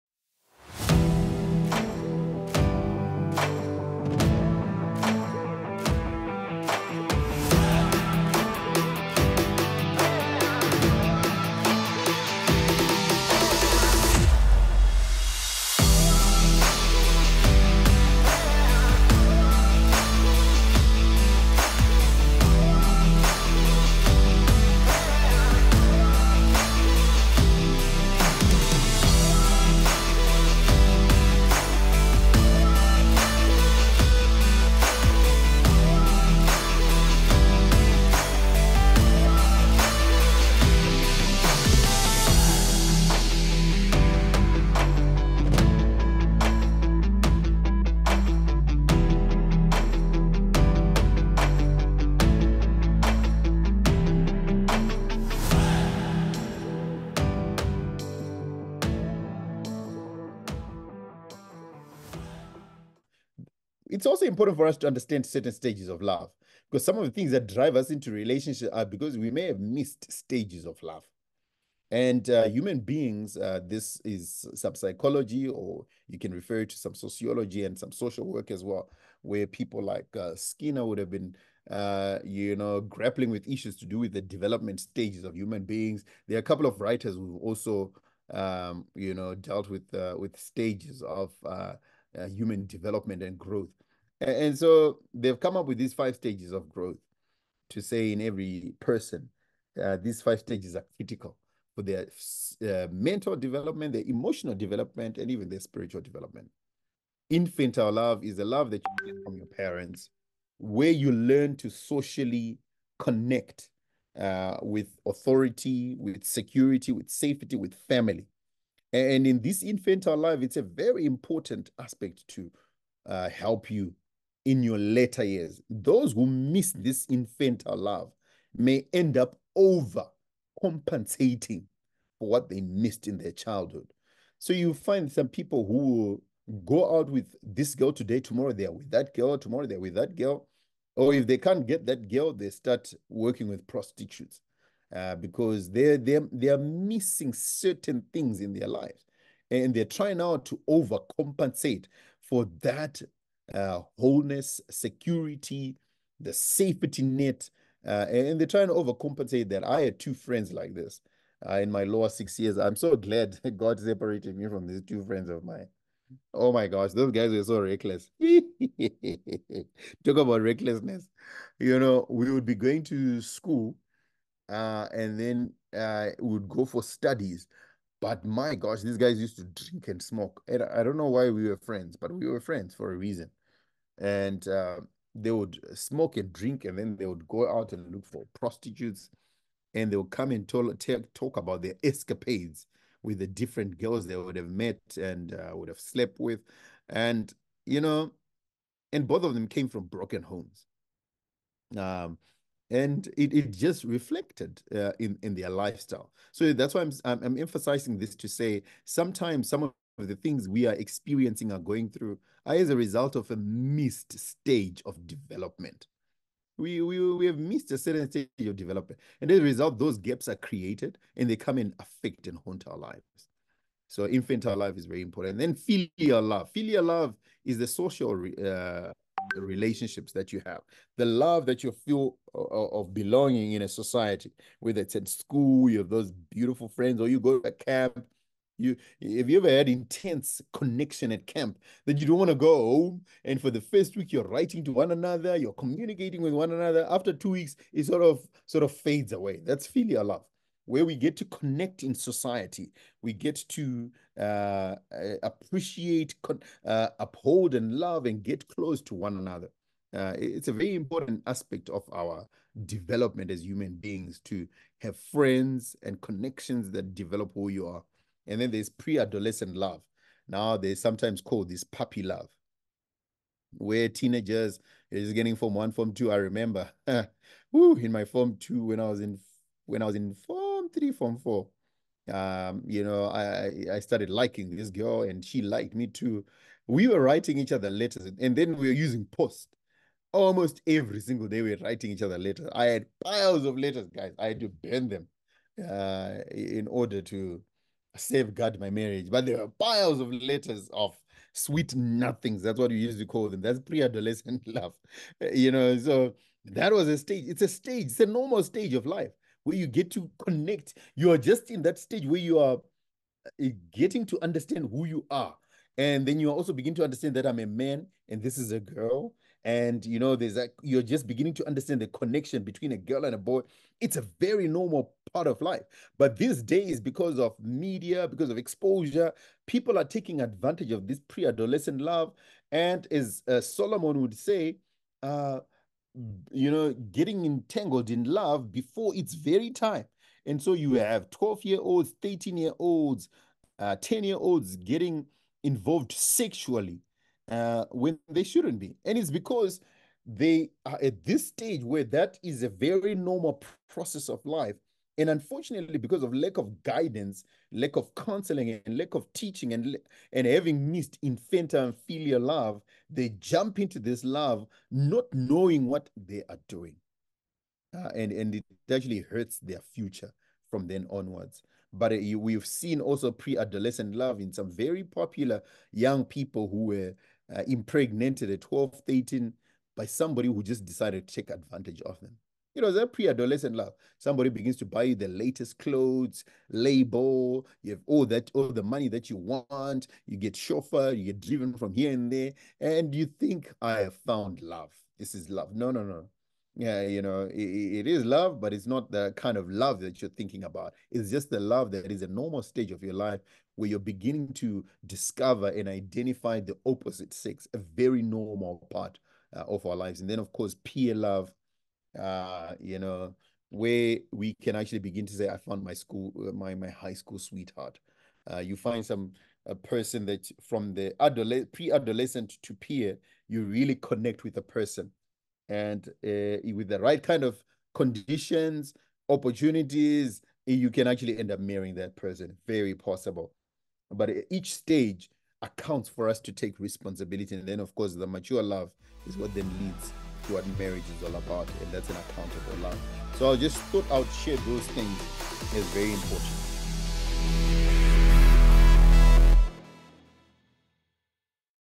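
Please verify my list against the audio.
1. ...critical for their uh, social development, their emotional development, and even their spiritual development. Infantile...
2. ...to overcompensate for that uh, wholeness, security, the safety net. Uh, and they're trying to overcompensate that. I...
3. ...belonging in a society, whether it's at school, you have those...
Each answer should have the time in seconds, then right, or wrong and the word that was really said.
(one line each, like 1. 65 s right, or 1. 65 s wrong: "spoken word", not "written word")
1. 100 s wrong: "mental", not "social"
2. 150 s right
3. 232 s right.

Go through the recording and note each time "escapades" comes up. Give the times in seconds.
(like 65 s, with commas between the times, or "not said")
191 s.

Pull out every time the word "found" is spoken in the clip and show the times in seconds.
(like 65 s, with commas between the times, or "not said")
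393 s, 415 s.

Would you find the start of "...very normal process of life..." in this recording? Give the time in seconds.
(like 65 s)
352 s.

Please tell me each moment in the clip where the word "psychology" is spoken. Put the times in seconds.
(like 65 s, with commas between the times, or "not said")
74 s.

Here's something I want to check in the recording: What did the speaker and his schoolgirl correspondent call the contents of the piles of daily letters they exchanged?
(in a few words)
Sweet nothings.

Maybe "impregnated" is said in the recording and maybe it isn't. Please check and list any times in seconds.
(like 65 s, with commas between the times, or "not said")
377 s.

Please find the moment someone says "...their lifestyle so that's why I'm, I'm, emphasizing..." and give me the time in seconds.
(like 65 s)
205 s.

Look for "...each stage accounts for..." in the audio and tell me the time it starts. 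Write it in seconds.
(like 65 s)
434 s.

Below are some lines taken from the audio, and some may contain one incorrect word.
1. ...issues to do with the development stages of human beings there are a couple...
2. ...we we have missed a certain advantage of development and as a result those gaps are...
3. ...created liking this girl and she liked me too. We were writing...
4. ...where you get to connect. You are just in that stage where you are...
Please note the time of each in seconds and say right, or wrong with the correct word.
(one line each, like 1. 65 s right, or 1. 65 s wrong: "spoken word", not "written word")
1. 83 s right
2. 216 s wrong: "stage", not "advantage"
3. 283 s wrong: "started", not "created"
4. 309 s right.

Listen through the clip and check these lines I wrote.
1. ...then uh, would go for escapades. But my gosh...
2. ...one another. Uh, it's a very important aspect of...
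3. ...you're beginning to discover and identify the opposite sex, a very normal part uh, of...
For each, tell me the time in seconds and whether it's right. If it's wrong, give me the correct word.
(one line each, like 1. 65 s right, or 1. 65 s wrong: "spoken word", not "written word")
1. 175 s wrong: "studies", not "escapades"
2. 258 s right
3. 403 s right.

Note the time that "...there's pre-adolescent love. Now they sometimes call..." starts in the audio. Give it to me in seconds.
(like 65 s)
268 s.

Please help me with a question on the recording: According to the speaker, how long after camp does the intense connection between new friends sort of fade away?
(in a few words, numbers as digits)
2 weeks.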